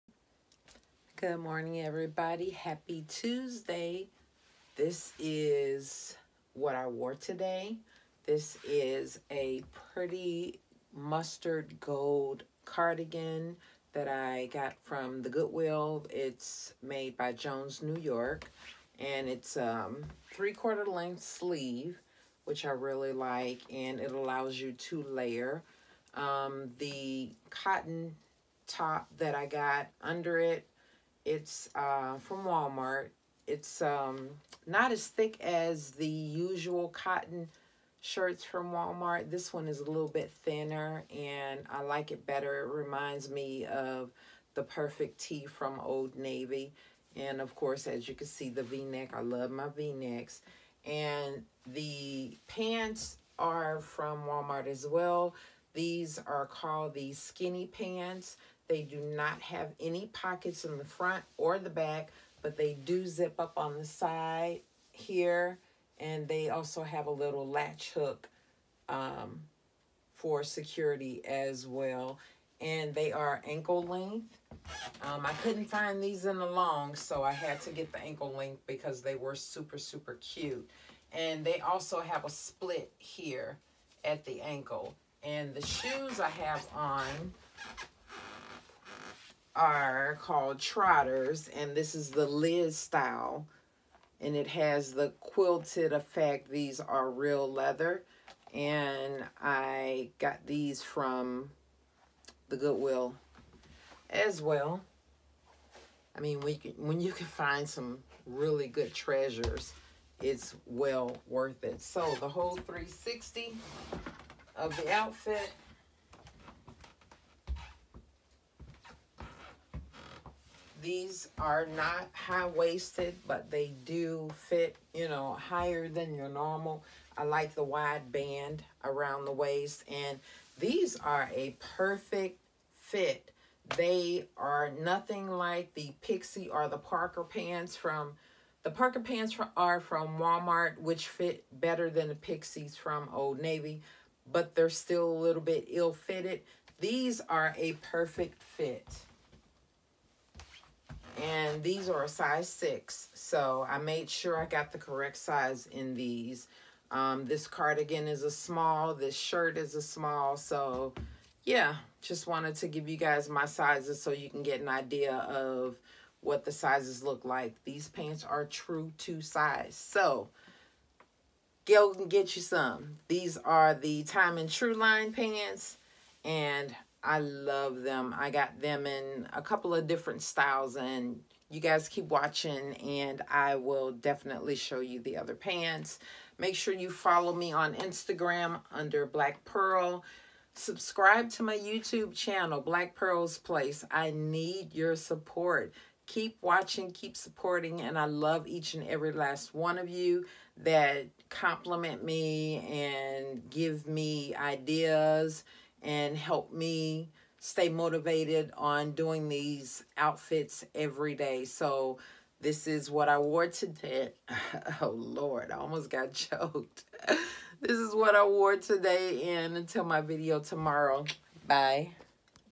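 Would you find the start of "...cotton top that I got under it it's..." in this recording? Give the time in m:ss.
0:27.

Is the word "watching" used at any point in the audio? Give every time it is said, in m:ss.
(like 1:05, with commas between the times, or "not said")
3:02, 3:16.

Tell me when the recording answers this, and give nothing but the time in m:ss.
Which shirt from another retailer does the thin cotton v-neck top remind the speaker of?
0:44.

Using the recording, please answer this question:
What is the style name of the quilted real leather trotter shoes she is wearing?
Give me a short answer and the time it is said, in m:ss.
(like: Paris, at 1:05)
Liz, at 1:32.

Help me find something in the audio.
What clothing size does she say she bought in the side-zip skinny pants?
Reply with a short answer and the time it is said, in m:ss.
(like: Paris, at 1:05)
6, at 2:32.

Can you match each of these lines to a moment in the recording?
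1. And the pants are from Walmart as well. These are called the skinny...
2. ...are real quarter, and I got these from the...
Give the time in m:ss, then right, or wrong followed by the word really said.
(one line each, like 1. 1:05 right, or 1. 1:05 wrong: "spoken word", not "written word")
1. 0:50 right
2. 1:36 wrong: "leather", not "quarter".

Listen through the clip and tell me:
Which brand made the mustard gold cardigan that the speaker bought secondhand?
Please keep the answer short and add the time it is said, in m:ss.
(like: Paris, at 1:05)
Jones New York, at 0:17.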